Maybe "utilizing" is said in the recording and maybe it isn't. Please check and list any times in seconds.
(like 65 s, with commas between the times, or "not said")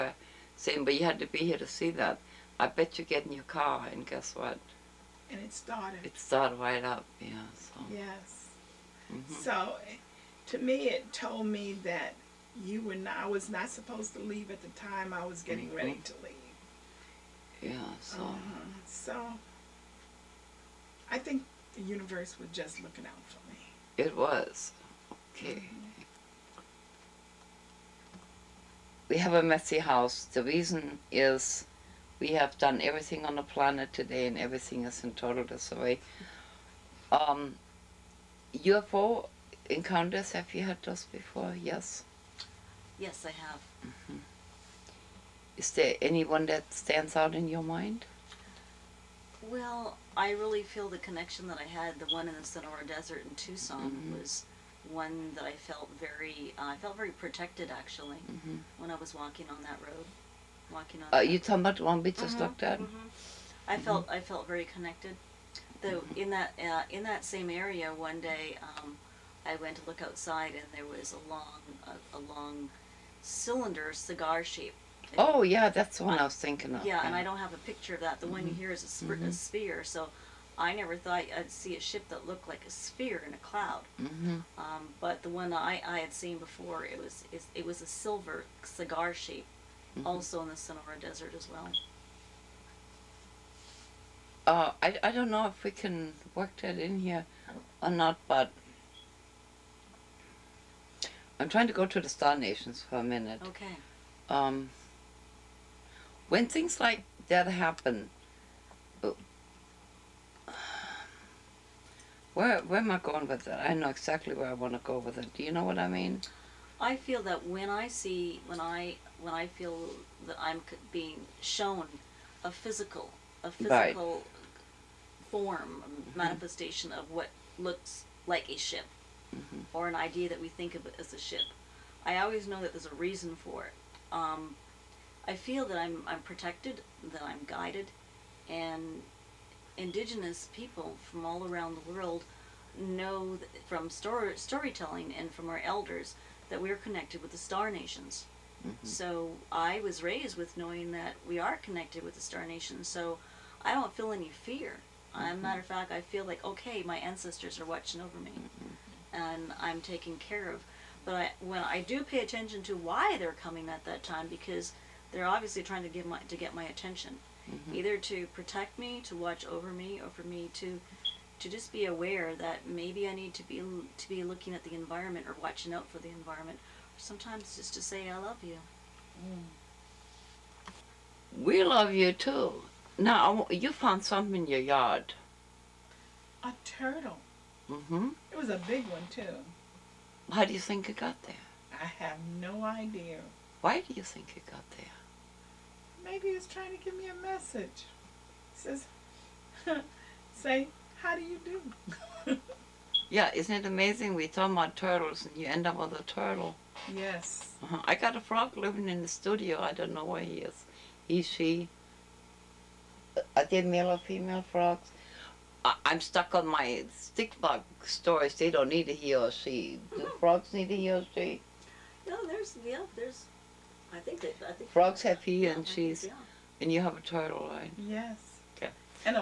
not said.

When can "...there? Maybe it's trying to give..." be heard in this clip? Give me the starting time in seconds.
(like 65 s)
194 s.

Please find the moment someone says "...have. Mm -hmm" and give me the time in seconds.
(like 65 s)
43 s.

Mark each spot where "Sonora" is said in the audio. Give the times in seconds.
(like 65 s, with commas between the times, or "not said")
52 s, 90 s.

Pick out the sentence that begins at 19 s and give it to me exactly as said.
So, I think the universe was just looking out for me.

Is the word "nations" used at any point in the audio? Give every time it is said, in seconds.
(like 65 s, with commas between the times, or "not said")
102 s, 147 s, 152 s.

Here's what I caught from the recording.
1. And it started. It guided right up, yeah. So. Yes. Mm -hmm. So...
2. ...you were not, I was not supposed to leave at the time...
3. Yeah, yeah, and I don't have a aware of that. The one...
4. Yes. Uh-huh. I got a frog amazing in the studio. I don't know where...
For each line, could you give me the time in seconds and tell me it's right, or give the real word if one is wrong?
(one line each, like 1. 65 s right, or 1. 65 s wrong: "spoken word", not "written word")
1. 5 s wrong: "started", not "guided"
2. 12 s right
3. 76 s wrong: "picture", not "aware"
4. 206 s wrong: "living", not "amazing".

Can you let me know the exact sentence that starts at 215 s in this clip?
I, am stuck on my stick bug stories.